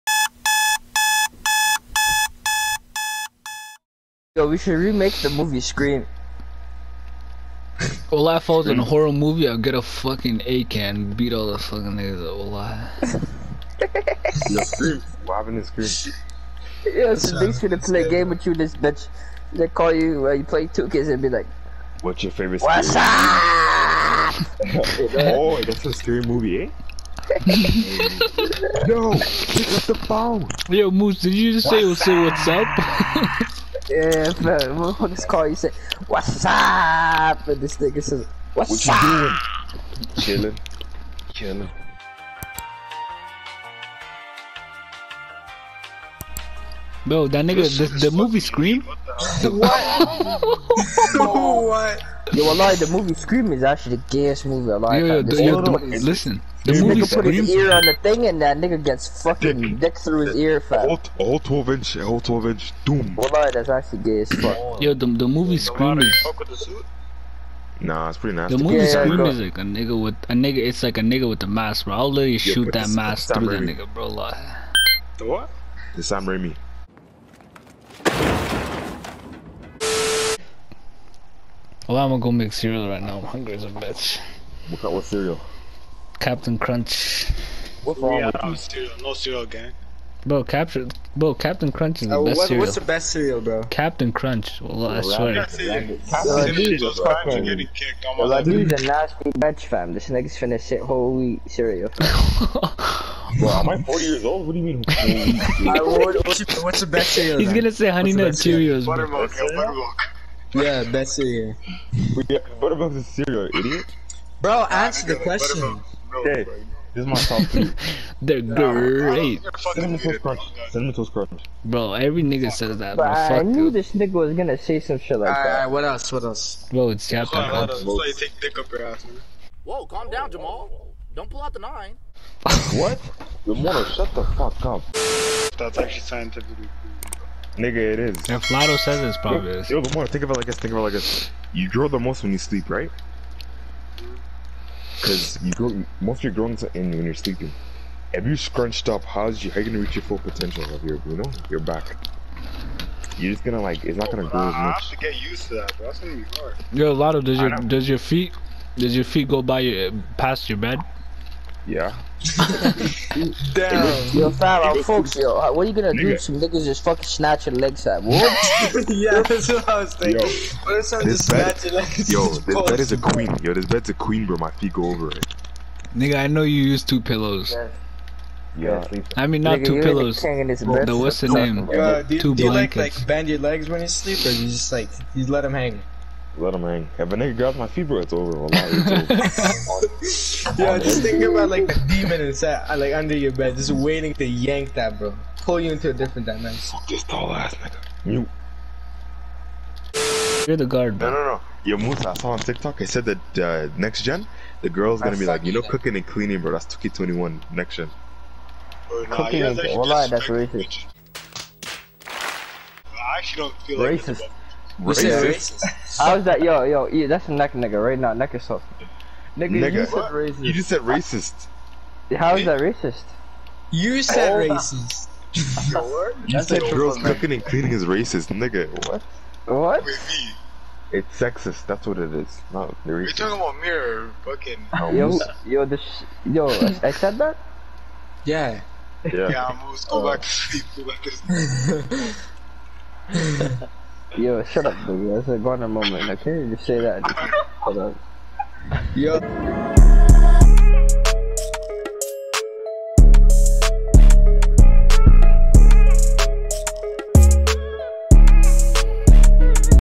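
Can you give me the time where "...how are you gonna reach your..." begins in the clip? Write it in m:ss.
2:29.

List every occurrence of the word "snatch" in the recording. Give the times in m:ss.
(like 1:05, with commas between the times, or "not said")
2:47, 2:51.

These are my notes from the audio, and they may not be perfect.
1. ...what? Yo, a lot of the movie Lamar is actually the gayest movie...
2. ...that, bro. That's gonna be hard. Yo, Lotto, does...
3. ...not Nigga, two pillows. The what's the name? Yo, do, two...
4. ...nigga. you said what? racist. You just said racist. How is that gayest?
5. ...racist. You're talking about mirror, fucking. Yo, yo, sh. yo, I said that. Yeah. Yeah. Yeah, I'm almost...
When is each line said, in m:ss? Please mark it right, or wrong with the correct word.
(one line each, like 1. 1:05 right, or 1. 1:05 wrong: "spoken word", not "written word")
1. 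0:51 wrong: "Scream", not "Lamar"
2. 2:35 right
3. 2:59 right
4. 3:39 wrong: "racist", not "gayest"
5. 3:52 right.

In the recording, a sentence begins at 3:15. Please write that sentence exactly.
Pull you into a different dimension.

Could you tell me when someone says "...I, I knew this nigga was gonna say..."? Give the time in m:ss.
2:03.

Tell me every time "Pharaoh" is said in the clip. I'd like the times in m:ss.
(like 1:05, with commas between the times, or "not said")
2:44.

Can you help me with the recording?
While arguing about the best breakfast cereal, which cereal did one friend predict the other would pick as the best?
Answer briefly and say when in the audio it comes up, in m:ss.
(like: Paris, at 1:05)
Honey Nut Cheerios, at 1:47.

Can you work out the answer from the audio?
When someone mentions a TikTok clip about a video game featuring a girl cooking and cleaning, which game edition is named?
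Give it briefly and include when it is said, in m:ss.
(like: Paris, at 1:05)
2K21, at 3:26.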